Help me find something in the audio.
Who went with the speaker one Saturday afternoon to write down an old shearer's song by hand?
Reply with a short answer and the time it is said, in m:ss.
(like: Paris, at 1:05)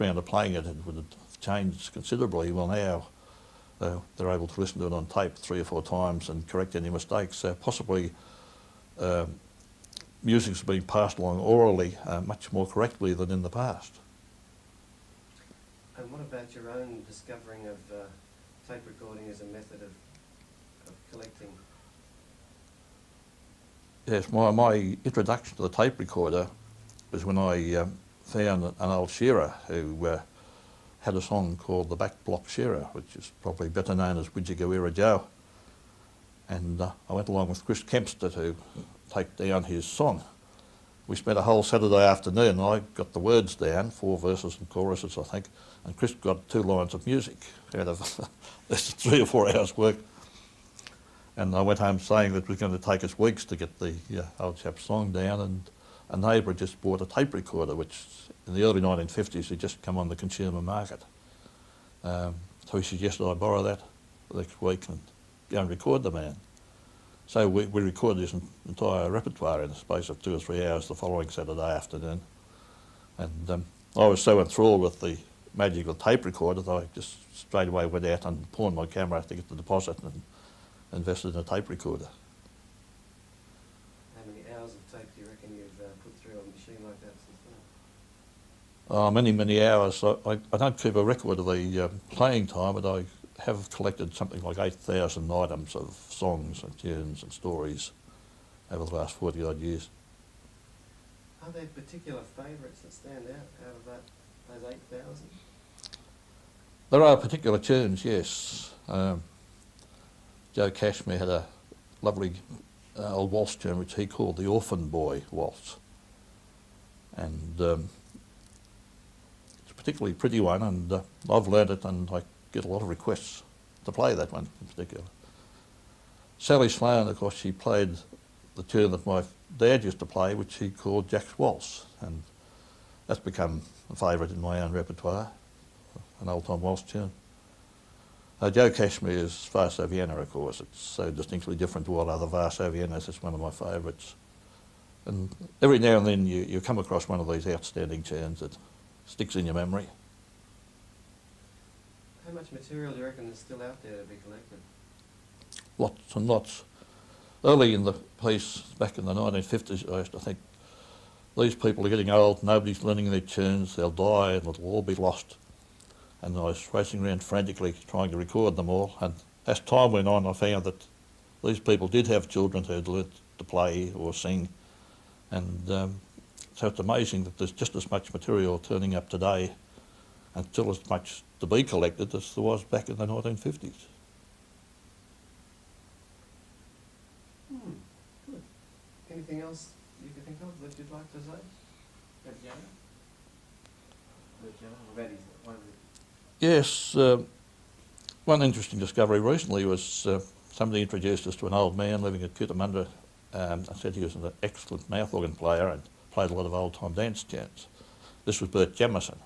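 Chris Kempster, at 0:37.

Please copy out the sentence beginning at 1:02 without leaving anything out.
Um, so he suggested I borrow that next week and go and record the man.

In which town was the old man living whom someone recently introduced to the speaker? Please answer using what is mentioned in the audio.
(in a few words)
Cootamundra.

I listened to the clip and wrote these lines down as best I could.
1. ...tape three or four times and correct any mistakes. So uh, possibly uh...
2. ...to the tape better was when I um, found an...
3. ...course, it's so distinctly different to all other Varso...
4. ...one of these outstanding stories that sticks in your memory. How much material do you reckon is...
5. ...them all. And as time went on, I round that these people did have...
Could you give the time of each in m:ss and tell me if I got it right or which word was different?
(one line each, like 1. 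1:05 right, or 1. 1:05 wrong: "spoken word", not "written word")
1. 0:05 right
2. 0:25 wrong: "recorder", not "better"
3. 2:20 right
4. 2:27 wrong: "tunes", not "stories"
5. 2:48 wrong: "found", not "round".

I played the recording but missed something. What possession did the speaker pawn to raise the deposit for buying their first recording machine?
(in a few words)
camera.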